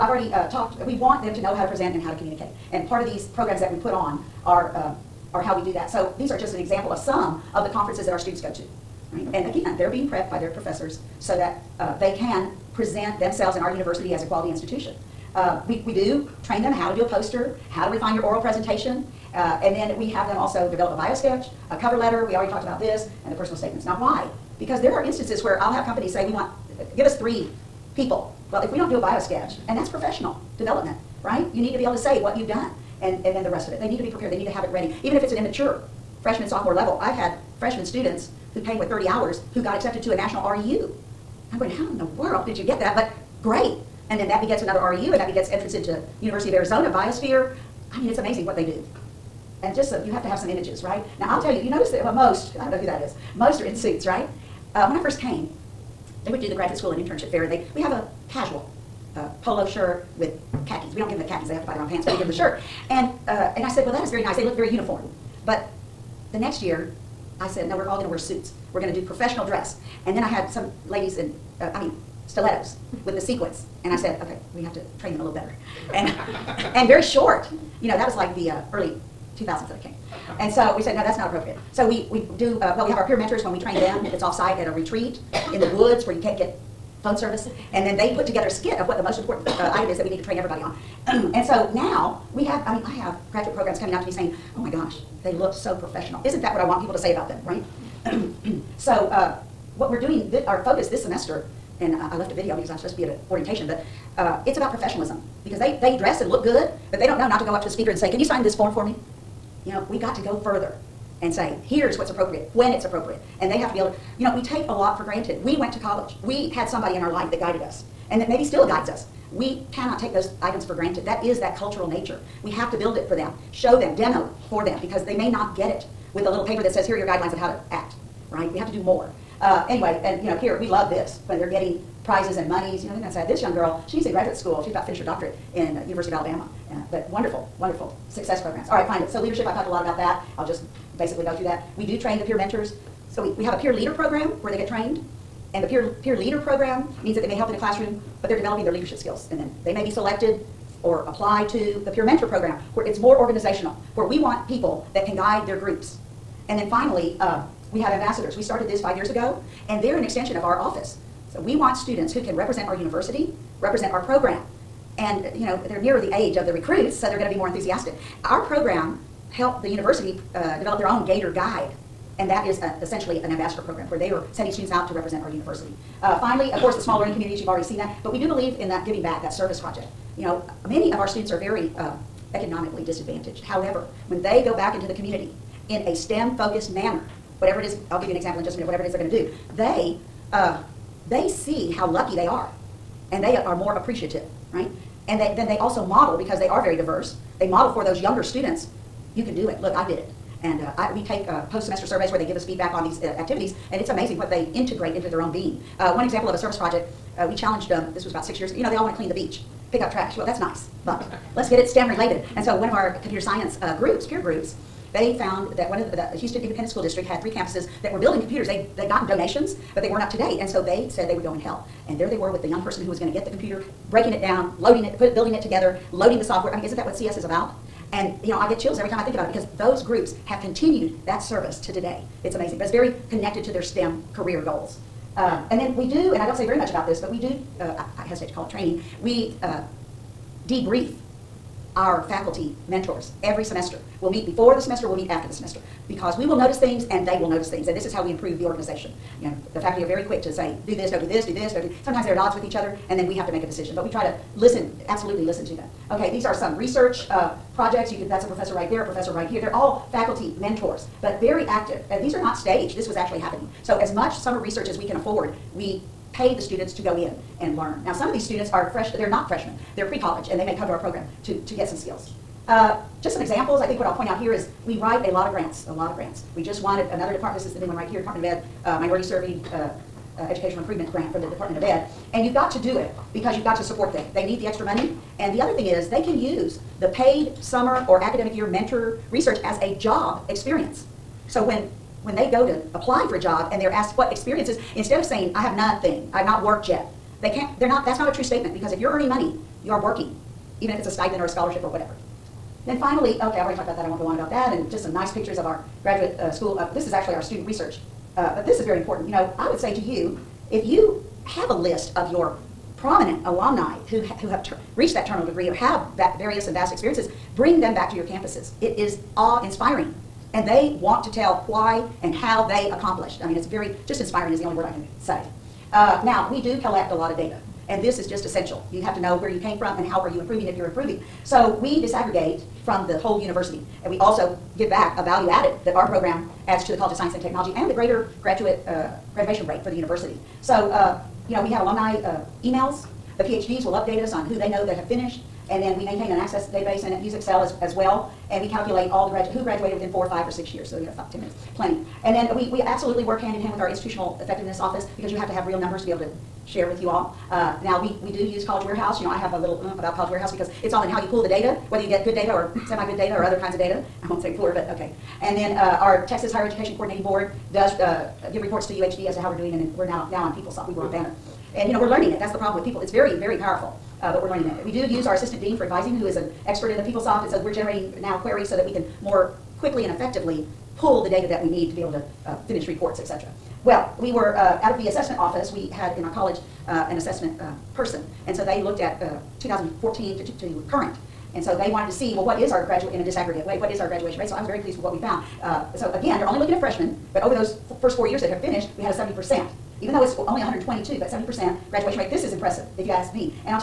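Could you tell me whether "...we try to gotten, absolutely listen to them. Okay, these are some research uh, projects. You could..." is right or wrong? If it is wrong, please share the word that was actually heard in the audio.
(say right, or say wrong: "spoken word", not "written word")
wrong: "listen", not "gotten".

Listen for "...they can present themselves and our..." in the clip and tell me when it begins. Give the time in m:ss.
0:11.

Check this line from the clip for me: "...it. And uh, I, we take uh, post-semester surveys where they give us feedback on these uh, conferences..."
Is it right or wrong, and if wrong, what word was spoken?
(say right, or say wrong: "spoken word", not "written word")
wrong: "activities", not "conferences".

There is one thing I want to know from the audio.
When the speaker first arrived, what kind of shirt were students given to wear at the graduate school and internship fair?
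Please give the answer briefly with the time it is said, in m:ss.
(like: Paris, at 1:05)
polo shirt, at 0:59.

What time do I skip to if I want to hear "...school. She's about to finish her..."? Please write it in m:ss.
2:14.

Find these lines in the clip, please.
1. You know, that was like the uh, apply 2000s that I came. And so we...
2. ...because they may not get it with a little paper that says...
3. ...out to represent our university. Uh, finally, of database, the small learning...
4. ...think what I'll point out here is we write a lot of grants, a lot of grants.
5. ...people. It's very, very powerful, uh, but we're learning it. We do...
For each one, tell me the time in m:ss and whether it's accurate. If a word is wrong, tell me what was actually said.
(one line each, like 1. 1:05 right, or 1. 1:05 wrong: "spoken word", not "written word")
1. 1:17 wrong: "early", not "apply"
2. 2:04 right
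3. 2:54 wrong: "course", not "database"
4. 4:33 right
5. 6:12 right.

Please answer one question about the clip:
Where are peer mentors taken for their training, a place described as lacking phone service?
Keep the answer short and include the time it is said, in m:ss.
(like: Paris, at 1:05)
a retreat in the woods, at 1:24.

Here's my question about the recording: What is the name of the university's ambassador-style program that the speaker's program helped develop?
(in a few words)
Gator Guide.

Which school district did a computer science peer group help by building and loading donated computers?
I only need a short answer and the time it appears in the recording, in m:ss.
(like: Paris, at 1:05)
Houston Independent School District, at 3:36.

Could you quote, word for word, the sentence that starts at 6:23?
Well, we were uh, out of the assessment office.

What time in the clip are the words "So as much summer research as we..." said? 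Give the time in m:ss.
4:23.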